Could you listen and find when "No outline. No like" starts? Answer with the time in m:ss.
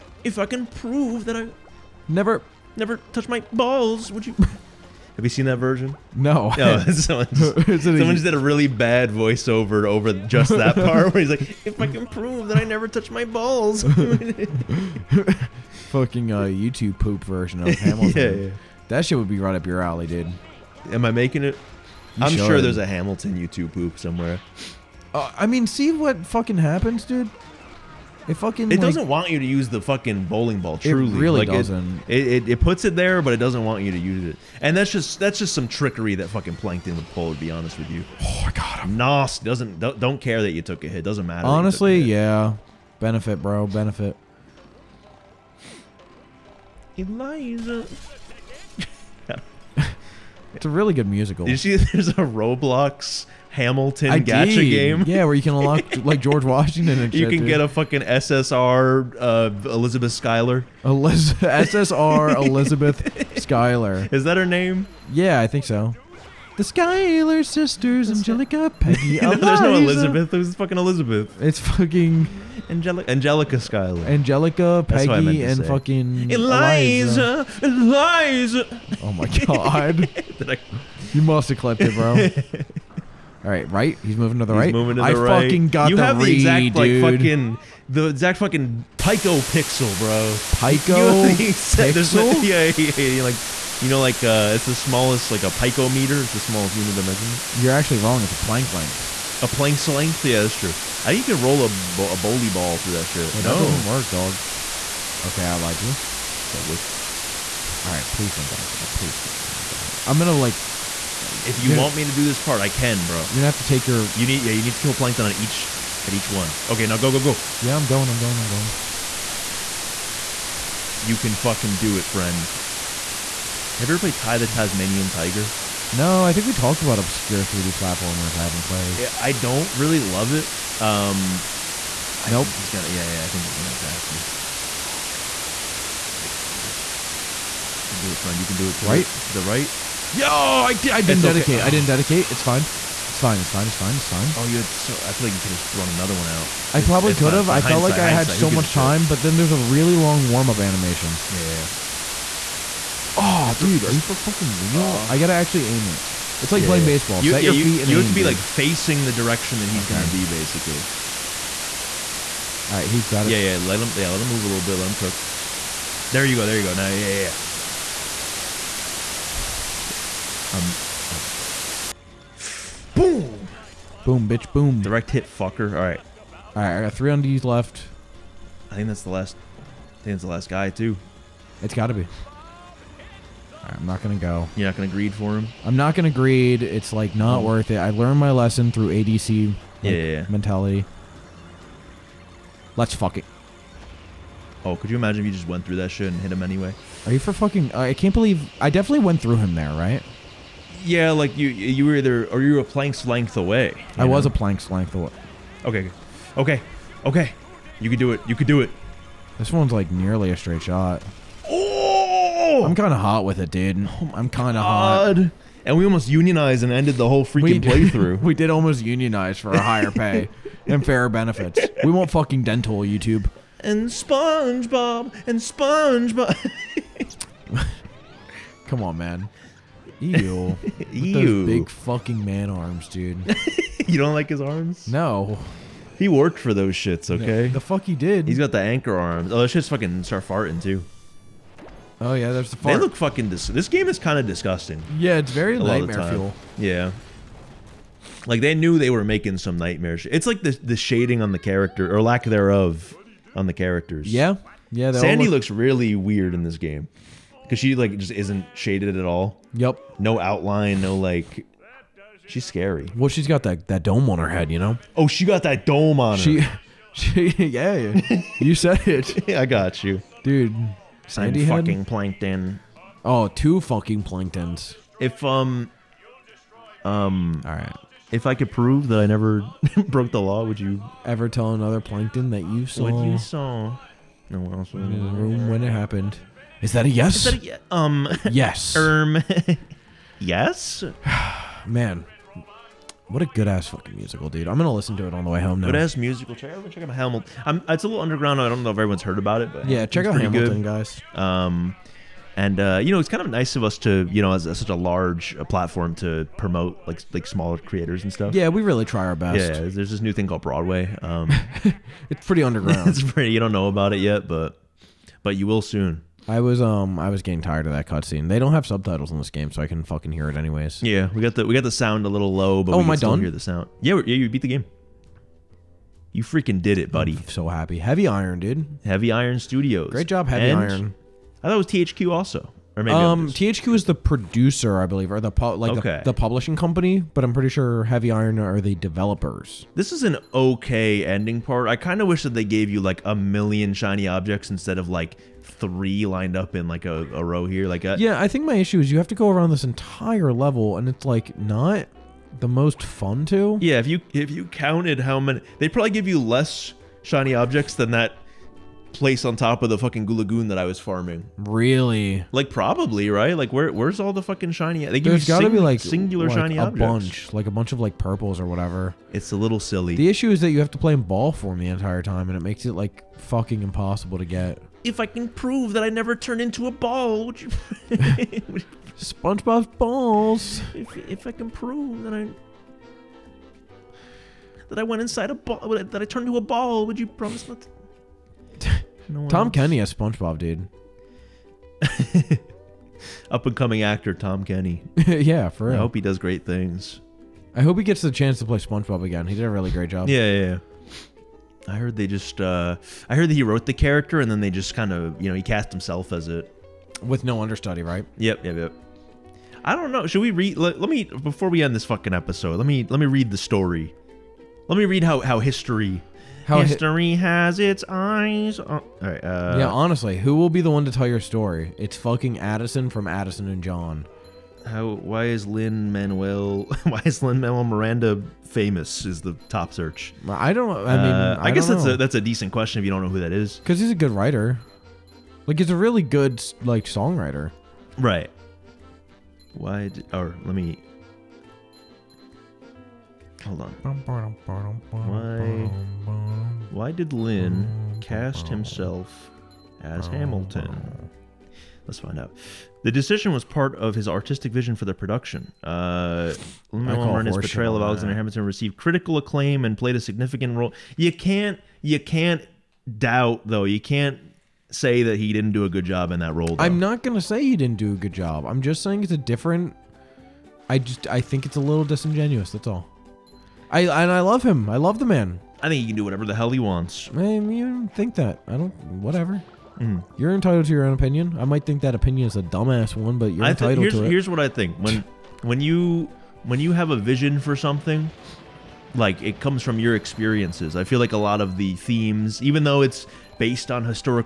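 4:19.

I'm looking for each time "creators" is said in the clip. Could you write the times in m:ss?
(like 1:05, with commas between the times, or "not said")
5:07.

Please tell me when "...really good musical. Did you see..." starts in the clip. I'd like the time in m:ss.
0:50.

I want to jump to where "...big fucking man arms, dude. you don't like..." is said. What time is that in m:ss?
3:51.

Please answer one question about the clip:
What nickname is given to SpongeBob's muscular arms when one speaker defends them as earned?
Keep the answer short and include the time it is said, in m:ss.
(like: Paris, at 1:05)
anchor arms, at 3:58.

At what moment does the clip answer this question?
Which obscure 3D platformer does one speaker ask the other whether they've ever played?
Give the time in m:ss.
2:04.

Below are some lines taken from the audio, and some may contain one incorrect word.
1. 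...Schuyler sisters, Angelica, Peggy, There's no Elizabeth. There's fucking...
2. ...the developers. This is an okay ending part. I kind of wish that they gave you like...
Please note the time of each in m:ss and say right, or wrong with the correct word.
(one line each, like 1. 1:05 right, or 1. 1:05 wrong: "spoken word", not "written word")
1. 1:06 right
2. 5:38 right.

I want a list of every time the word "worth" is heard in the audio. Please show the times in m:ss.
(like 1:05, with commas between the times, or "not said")
3:07.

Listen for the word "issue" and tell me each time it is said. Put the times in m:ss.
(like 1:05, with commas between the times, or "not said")
5:48, 6:10.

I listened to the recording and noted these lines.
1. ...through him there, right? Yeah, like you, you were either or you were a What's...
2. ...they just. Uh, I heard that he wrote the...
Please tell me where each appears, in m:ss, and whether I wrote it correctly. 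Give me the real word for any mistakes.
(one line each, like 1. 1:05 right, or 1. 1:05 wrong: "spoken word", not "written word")
1. 3:19 wrong: "Planck", not "What"
2. 6:41 right.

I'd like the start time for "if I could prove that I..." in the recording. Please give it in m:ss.
4:38.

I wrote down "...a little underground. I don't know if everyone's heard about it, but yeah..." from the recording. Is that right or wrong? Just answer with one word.
right.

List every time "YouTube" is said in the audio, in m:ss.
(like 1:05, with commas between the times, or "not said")
0:16, 0:23, 3:42.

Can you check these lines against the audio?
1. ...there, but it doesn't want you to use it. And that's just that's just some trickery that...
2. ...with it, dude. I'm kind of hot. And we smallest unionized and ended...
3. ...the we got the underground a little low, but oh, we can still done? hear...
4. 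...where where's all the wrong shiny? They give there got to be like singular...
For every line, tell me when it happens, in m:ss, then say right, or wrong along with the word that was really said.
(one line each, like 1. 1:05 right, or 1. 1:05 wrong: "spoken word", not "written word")
1. 0:32 right
2. 3:33 wrong: "almost", not "smallest"
3. 5:21 wrong: "sound", not "underground"
4. 6:03 wrong: "fucking", not "wrong".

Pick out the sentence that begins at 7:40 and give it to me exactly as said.
You can't, you can't doubt though.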